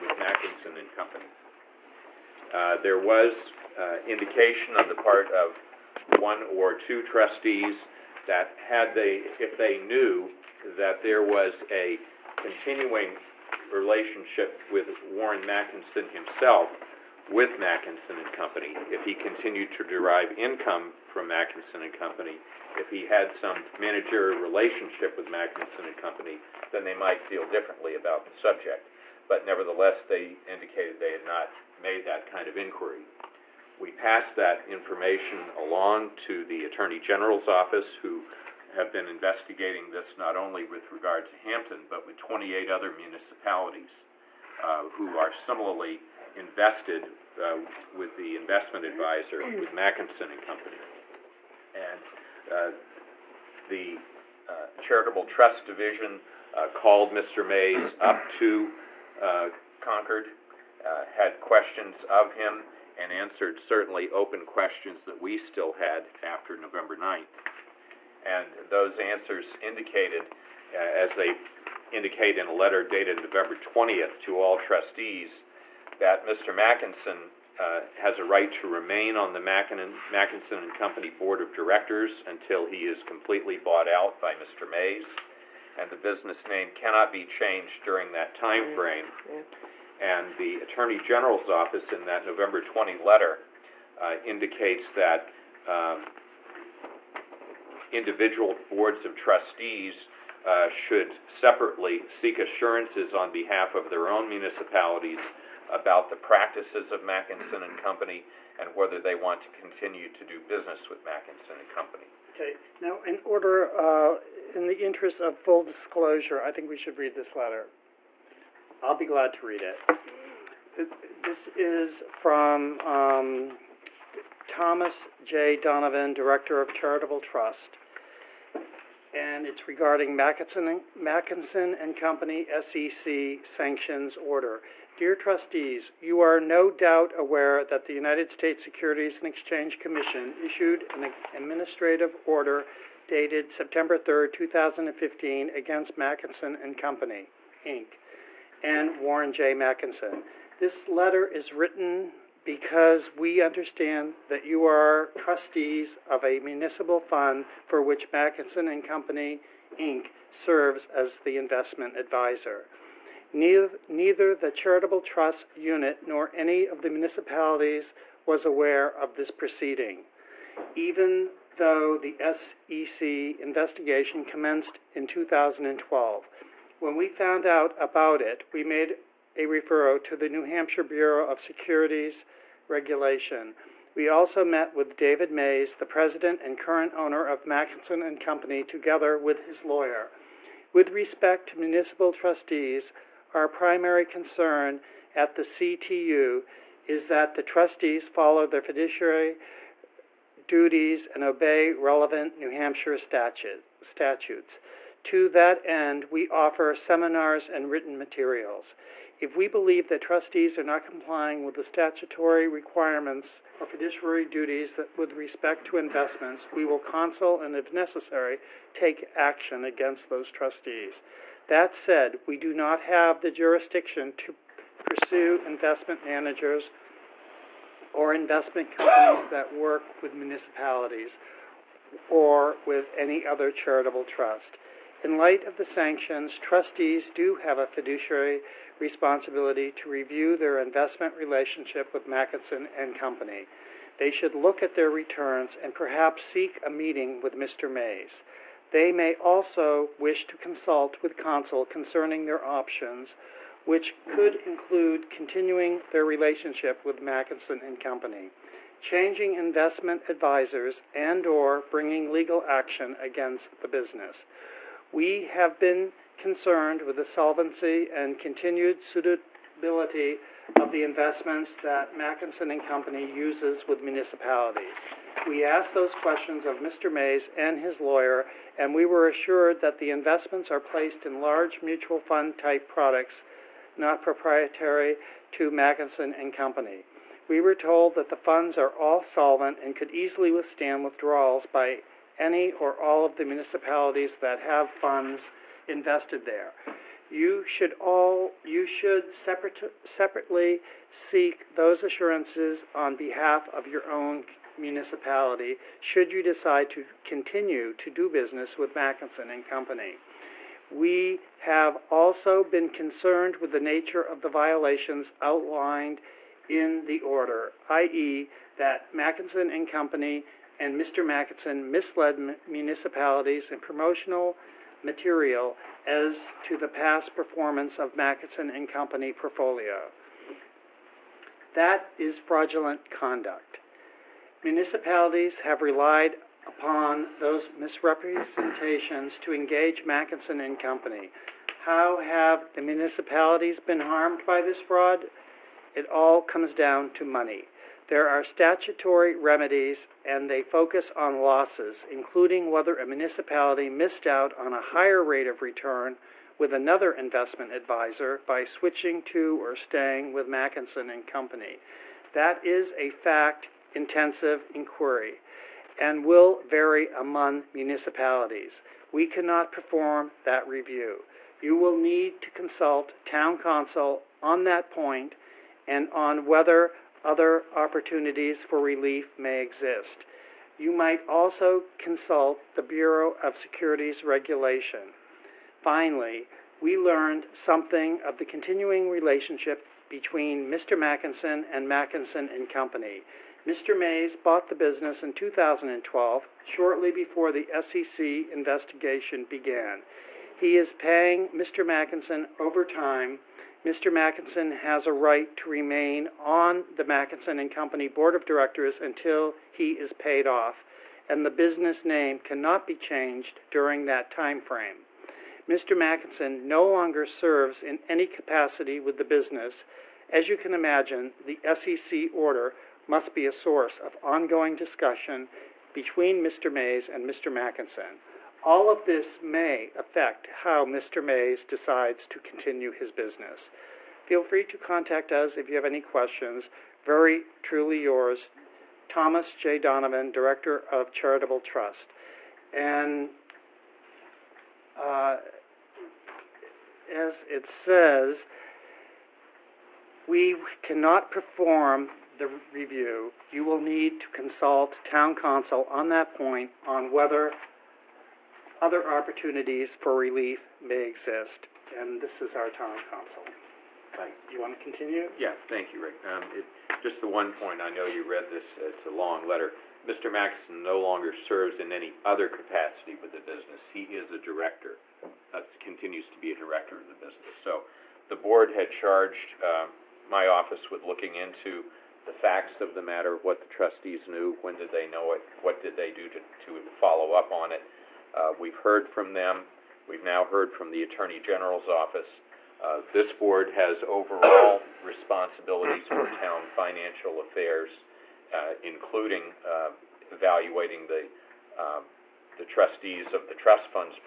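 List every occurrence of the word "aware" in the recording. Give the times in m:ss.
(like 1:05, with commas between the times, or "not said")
2:17, 2:48.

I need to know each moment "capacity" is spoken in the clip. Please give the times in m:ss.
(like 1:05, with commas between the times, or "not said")
6:58, 7:52.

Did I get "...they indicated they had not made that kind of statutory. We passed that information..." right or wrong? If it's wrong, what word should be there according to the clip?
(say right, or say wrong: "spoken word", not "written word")
wrong: "inquiry", not "statutory".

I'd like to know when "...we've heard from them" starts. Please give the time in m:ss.
8:08.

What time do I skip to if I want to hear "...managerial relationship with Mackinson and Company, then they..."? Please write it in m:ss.
0:23.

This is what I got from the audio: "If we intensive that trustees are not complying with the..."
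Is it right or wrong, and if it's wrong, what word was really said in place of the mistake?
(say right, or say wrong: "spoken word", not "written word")
wrong: "believe", not "intensive".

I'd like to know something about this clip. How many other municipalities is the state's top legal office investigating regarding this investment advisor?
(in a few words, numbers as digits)
28.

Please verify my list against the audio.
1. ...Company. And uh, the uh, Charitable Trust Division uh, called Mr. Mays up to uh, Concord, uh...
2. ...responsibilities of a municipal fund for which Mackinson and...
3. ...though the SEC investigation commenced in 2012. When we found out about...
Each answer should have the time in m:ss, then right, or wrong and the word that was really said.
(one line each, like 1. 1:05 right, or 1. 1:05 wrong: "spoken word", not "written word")
1. 0:50 right
2. 2:35 wrong: "trustees", not "responsibilities"
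3. 2:51 right.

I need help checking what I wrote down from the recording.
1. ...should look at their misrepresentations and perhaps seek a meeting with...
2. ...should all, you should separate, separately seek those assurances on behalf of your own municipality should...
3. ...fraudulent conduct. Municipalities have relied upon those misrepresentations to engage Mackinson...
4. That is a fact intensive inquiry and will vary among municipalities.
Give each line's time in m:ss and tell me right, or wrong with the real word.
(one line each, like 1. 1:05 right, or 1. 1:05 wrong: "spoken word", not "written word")
1. 4:04 wrong: "returns", not "misrepresentations"
2. 4:57 right
3. 5:32 right
4. 6:02 right.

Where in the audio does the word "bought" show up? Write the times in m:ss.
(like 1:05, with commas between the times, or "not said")
1:23, 6:34.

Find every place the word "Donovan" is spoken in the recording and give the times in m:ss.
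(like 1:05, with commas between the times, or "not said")
2:05, 7:19.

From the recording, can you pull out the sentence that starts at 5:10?
We have also been concerned with the nature of the violations outlined in the order, i.e., that Mackinson and Company and Mr.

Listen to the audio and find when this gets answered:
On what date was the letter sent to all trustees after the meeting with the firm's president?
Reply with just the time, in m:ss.
1:13.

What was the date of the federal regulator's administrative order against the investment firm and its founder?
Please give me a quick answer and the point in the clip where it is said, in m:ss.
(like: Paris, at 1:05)
September 3rd, 2015, at 2:23.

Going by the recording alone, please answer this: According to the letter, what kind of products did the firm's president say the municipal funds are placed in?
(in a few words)
large mutual fund type products.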